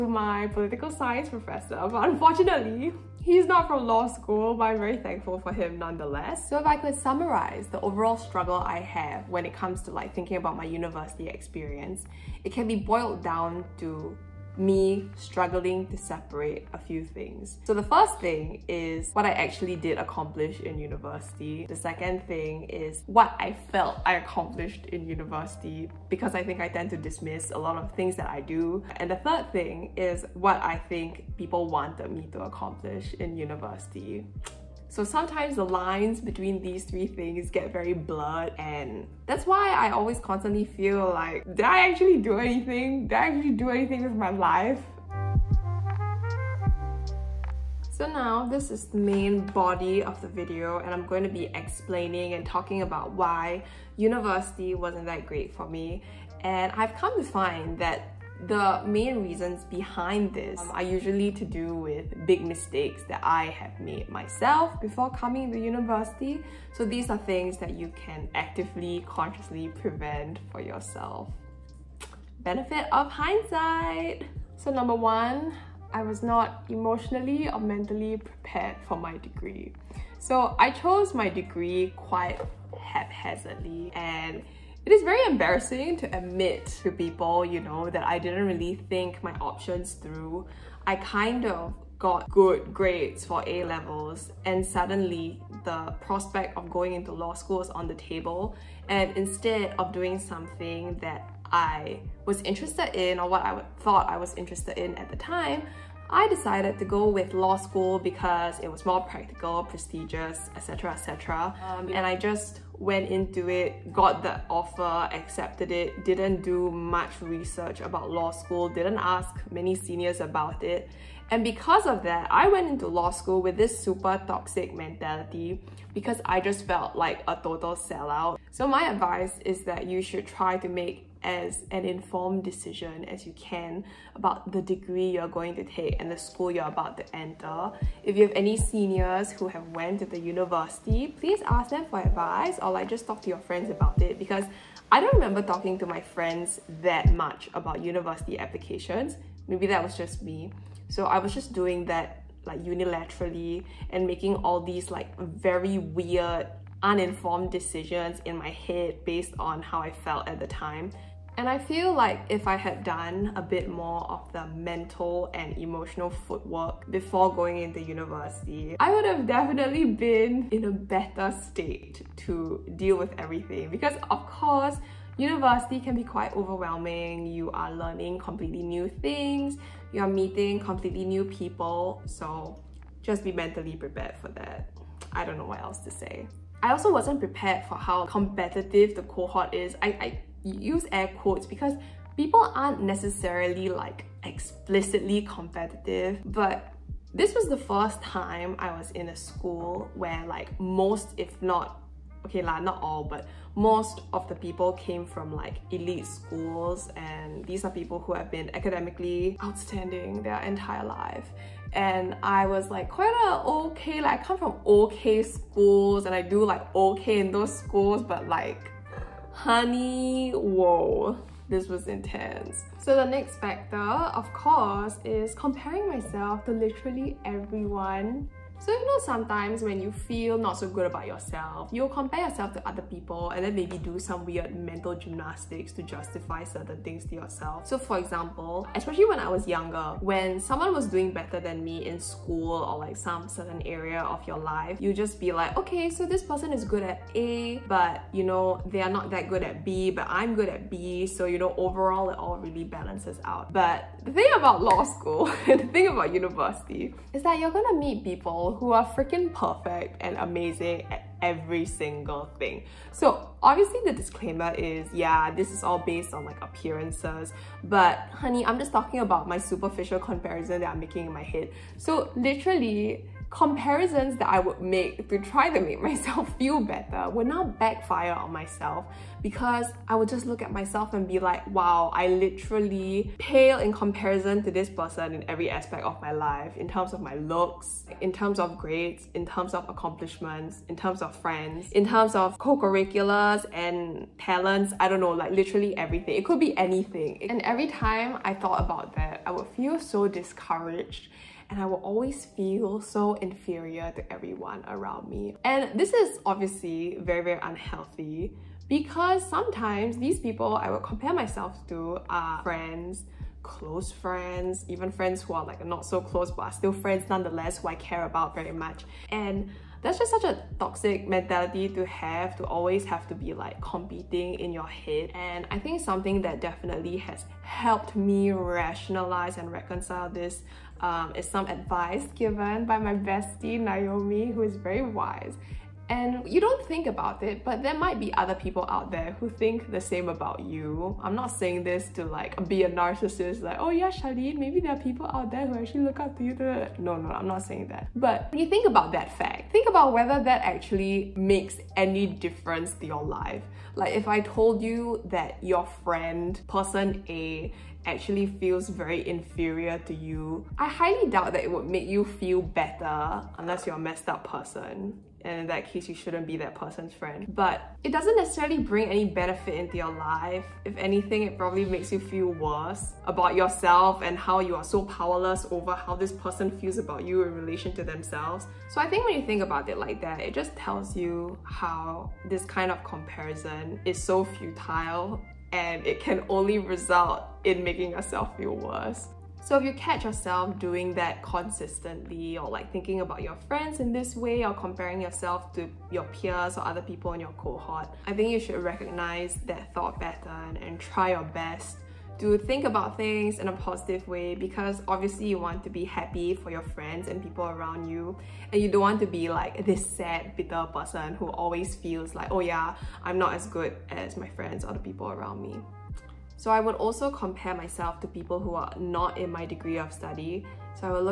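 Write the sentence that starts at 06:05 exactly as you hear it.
And in that case, you shouldn't be that person's friend.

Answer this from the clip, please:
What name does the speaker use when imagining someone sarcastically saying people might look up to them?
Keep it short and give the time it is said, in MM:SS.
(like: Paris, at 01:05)
Charlene, at 05:43.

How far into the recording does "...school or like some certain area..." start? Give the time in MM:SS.
04:01.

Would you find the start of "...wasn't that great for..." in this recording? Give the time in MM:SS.
00:54.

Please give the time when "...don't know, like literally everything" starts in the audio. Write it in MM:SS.
04:54.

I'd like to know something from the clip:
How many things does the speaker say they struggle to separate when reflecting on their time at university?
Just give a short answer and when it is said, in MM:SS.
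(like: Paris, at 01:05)
3, at 00:36.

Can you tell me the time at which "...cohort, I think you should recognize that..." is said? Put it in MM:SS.
06:37.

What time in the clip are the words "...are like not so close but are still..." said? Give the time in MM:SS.
05:15.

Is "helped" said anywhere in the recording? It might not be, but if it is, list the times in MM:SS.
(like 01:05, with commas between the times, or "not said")
05:27.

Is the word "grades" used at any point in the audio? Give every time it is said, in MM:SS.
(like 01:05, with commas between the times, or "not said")
01:32, 04:48.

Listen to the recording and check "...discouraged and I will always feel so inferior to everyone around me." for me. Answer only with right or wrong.
right.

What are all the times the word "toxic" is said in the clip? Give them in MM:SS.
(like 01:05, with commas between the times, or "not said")
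02:04, 05:20.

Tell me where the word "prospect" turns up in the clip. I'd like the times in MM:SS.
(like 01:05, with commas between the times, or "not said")
01:36.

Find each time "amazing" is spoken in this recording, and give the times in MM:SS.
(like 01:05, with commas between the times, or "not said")
04:20.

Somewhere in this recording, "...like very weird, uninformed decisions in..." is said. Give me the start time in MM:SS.
02:34.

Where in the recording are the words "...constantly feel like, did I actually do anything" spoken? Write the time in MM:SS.
00:40.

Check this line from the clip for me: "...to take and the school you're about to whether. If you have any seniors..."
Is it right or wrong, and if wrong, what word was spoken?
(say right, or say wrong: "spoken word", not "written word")
wrong: "enter", not "whether".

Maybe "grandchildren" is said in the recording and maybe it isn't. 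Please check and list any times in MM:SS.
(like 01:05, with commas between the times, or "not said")
not said.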